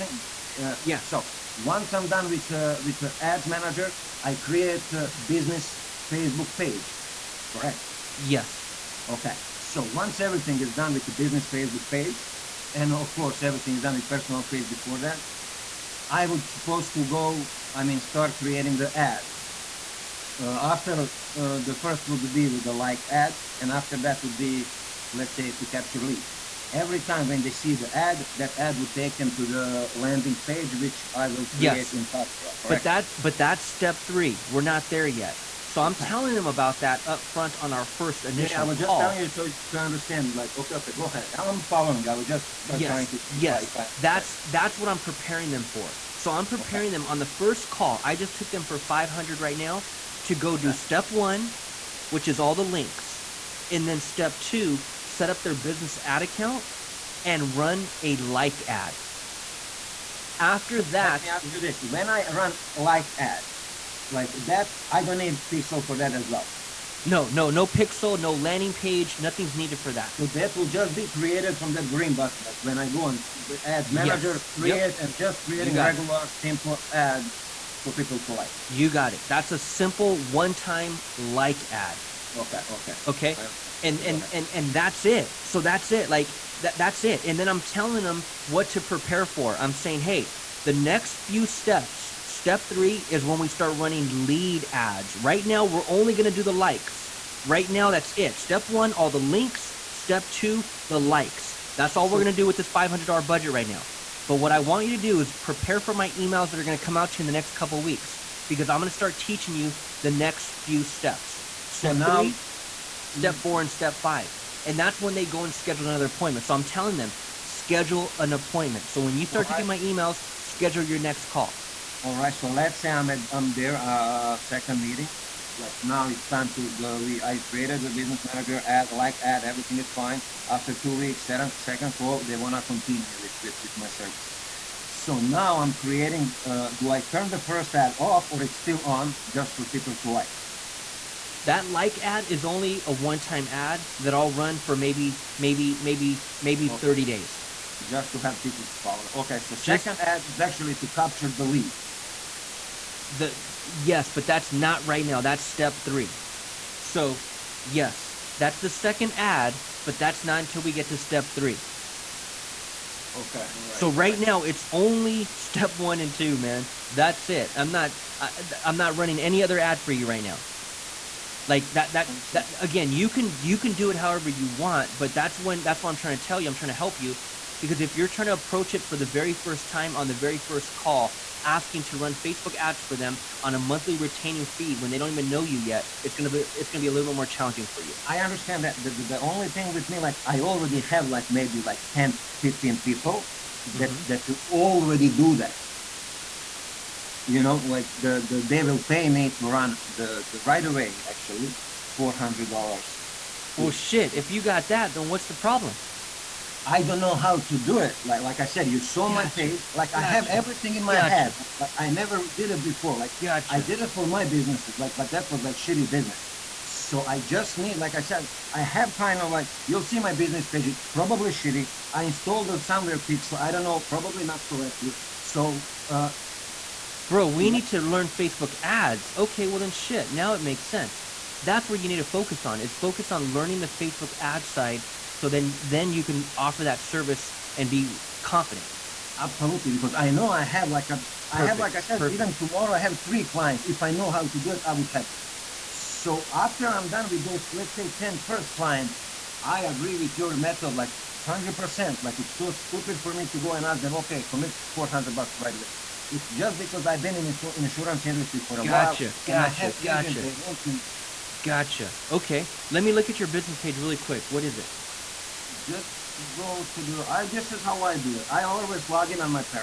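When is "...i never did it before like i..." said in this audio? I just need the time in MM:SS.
03:31.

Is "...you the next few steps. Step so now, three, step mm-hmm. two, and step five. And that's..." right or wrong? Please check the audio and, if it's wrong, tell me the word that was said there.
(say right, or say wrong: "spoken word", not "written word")
wrong: "four", not "two".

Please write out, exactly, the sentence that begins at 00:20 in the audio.
Uh, after uh, the first would be the like ad, and after that would be, let's say, to capture leads.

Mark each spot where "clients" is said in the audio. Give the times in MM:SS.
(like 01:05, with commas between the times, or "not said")
04:03, 04:08.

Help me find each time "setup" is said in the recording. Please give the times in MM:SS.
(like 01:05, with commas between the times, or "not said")
not said.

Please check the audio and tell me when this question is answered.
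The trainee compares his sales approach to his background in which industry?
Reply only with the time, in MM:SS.
04:17.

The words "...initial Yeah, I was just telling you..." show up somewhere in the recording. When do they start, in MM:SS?
00:38.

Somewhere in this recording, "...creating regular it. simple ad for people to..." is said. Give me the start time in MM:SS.
01:15.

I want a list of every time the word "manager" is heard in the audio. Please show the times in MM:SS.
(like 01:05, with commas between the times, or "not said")
00:03, 01:13, 02:08.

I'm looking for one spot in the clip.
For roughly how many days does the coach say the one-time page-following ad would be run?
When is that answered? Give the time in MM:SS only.
02:26.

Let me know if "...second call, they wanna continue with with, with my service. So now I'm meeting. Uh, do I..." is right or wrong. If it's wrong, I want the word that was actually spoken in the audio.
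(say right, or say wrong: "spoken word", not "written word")
wrong: "creating", not "meeting".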